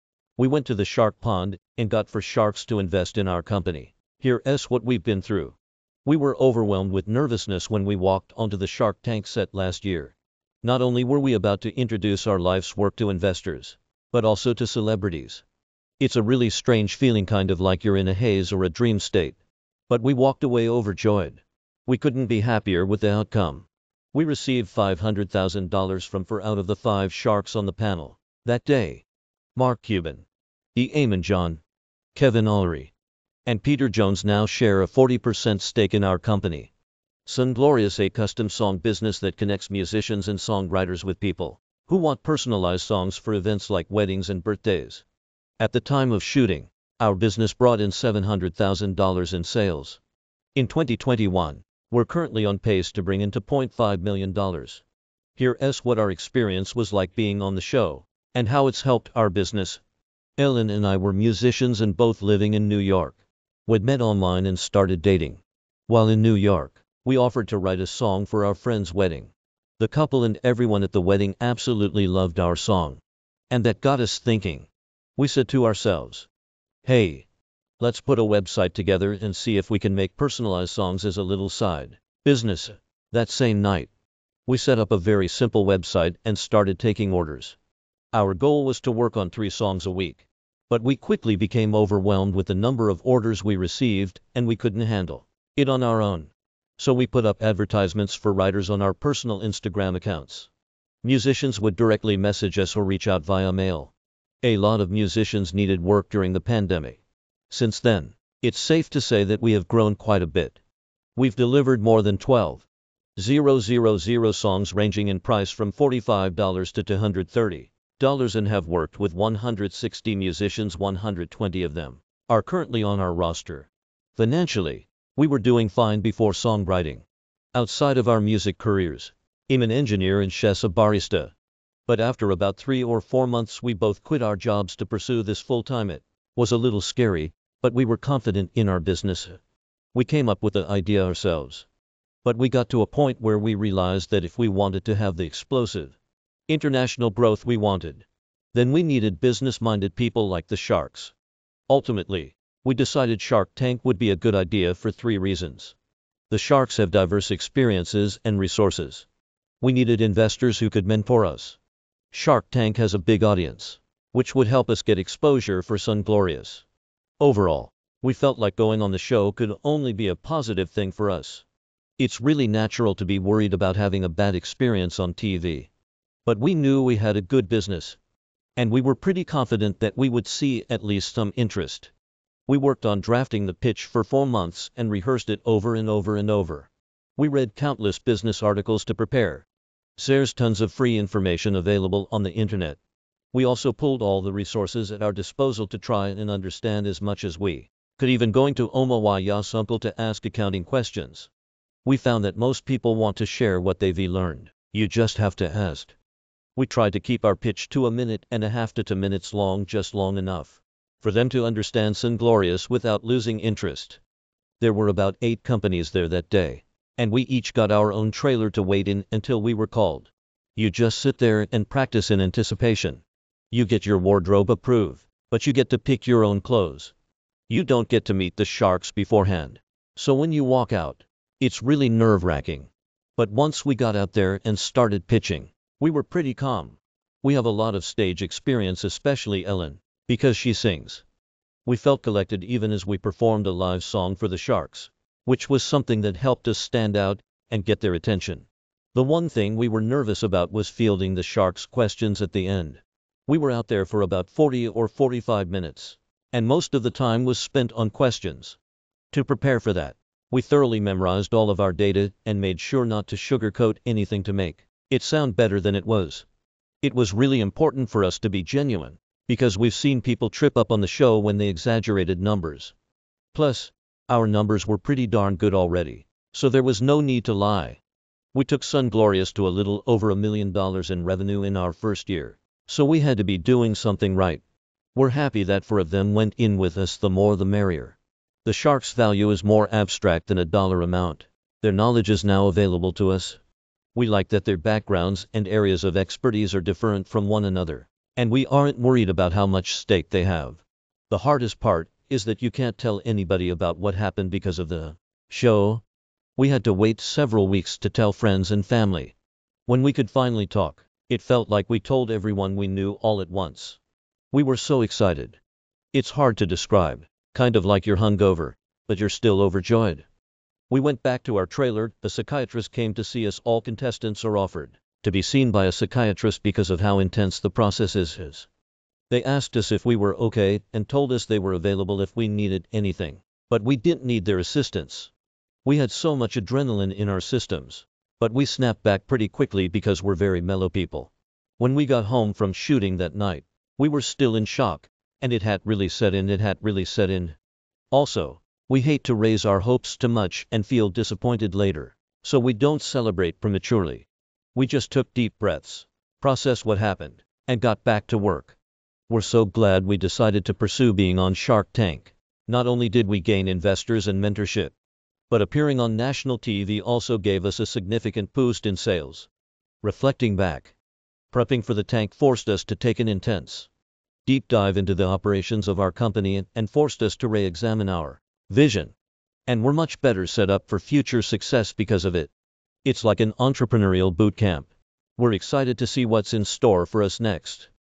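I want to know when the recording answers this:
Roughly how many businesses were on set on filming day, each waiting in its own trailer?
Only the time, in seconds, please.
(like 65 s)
215 s.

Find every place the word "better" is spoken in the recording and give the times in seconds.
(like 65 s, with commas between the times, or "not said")
265 s, 380 s.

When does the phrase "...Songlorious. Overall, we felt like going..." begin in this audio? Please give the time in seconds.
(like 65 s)
165 s.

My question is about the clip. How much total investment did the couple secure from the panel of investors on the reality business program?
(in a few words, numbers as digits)
$500,000.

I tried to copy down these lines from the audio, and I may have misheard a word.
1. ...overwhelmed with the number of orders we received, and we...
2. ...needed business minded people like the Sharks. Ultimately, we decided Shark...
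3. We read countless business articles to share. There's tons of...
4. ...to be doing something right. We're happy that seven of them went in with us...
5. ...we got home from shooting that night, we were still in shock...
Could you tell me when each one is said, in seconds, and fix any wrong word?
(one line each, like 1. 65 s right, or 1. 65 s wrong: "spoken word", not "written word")
1. 91 s right
2. 148 s right
3. 187 s wrong: "prepare", not "share"
4. 283 s wrong: "four", not "seven"
5. 341 s right.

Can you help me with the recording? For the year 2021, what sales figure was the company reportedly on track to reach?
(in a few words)
$2.5 million.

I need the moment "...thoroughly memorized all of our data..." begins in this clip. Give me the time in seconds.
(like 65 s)
260 s.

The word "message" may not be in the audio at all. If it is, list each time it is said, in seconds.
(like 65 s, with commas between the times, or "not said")
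102 s.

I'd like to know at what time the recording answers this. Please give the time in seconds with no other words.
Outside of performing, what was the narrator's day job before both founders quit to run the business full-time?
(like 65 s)
129 s.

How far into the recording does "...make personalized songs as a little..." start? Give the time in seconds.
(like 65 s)
79 s.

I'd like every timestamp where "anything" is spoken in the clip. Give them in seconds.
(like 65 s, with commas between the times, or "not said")
263 s, 332 s.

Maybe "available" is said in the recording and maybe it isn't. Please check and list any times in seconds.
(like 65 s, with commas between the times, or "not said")
191 s, 292 s, 331 s.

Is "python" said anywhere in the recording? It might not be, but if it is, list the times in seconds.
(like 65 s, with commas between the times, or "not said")
not said.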